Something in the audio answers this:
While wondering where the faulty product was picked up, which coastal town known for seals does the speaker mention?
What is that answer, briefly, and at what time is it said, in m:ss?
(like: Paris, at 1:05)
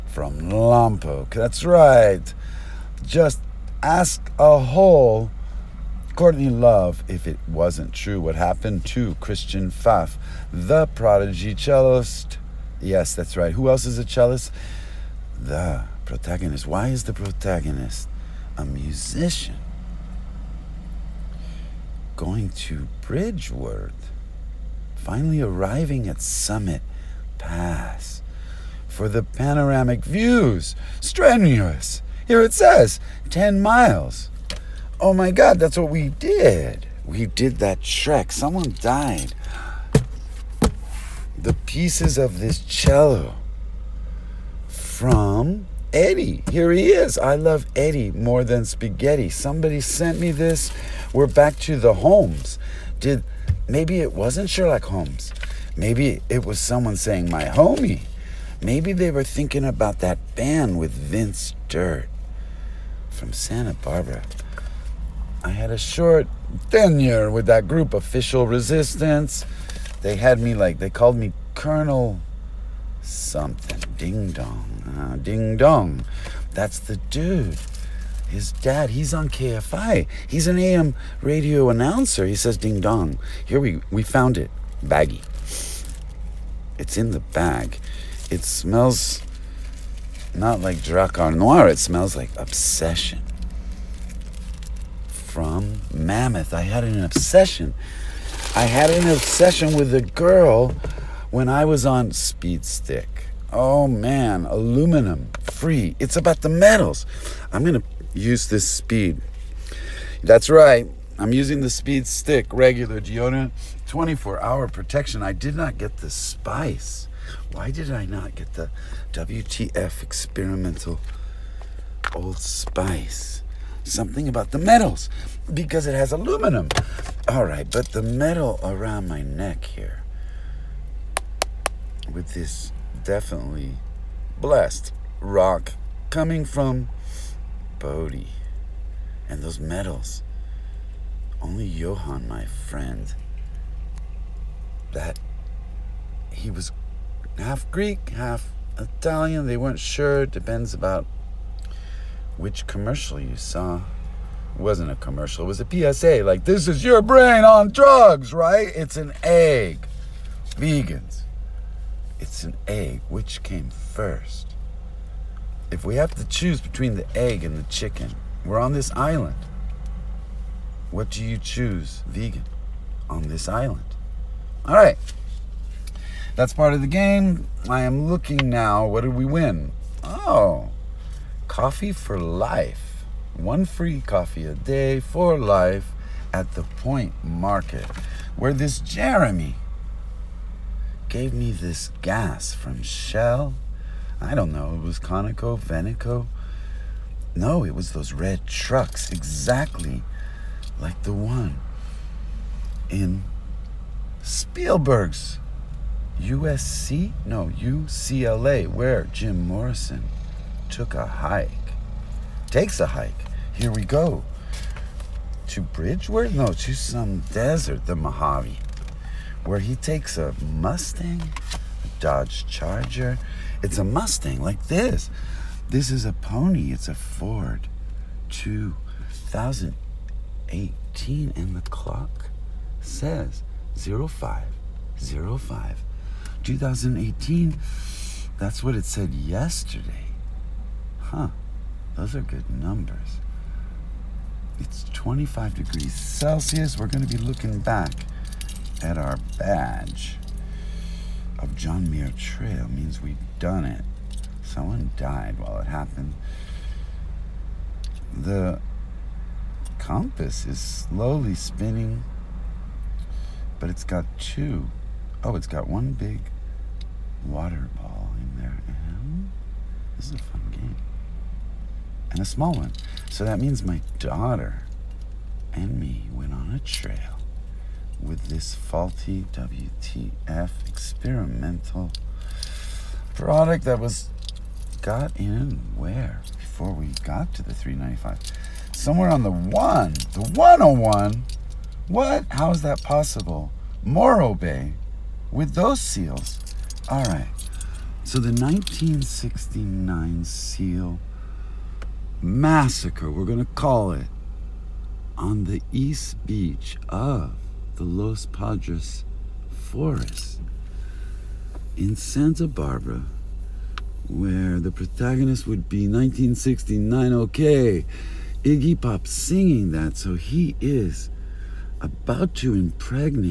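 Morro Bay, at 4:53.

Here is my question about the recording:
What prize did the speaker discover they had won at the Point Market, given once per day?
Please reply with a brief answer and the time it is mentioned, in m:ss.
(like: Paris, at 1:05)
Coffee for life, at 3:01.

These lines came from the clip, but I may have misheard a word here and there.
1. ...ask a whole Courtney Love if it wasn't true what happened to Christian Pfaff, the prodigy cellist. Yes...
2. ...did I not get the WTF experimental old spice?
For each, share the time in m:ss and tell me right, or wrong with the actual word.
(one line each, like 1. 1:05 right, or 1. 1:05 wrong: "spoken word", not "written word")
1. 0:03 right
2. 1:57 right.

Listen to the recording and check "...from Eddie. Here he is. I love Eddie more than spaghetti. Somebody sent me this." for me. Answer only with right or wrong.
right.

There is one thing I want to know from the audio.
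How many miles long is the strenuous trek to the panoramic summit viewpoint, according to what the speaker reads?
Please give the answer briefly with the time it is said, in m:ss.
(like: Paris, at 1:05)
10, at 0:33.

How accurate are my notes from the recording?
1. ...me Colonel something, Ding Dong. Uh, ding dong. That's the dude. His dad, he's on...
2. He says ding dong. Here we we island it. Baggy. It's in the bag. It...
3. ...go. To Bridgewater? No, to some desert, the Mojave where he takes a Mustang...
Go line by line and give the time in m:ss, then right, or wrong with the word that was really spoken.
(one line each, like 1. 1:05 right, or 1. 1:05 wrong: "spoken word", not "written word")
1. 1:11 right
2. 1:22 wrong: "found", not "island"
3. 3:33 right.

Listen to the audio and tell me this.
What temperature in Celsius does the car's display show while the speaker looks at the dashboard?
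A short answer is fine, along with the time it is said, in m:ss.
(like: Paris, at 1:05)
25 degrees, at 4:04.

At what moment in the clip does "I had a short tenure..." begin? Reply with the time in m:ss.
1:05.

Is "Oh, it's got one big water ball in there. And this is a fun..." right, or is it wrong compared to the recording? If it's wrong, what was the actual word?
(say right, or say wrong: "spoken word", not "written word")
right.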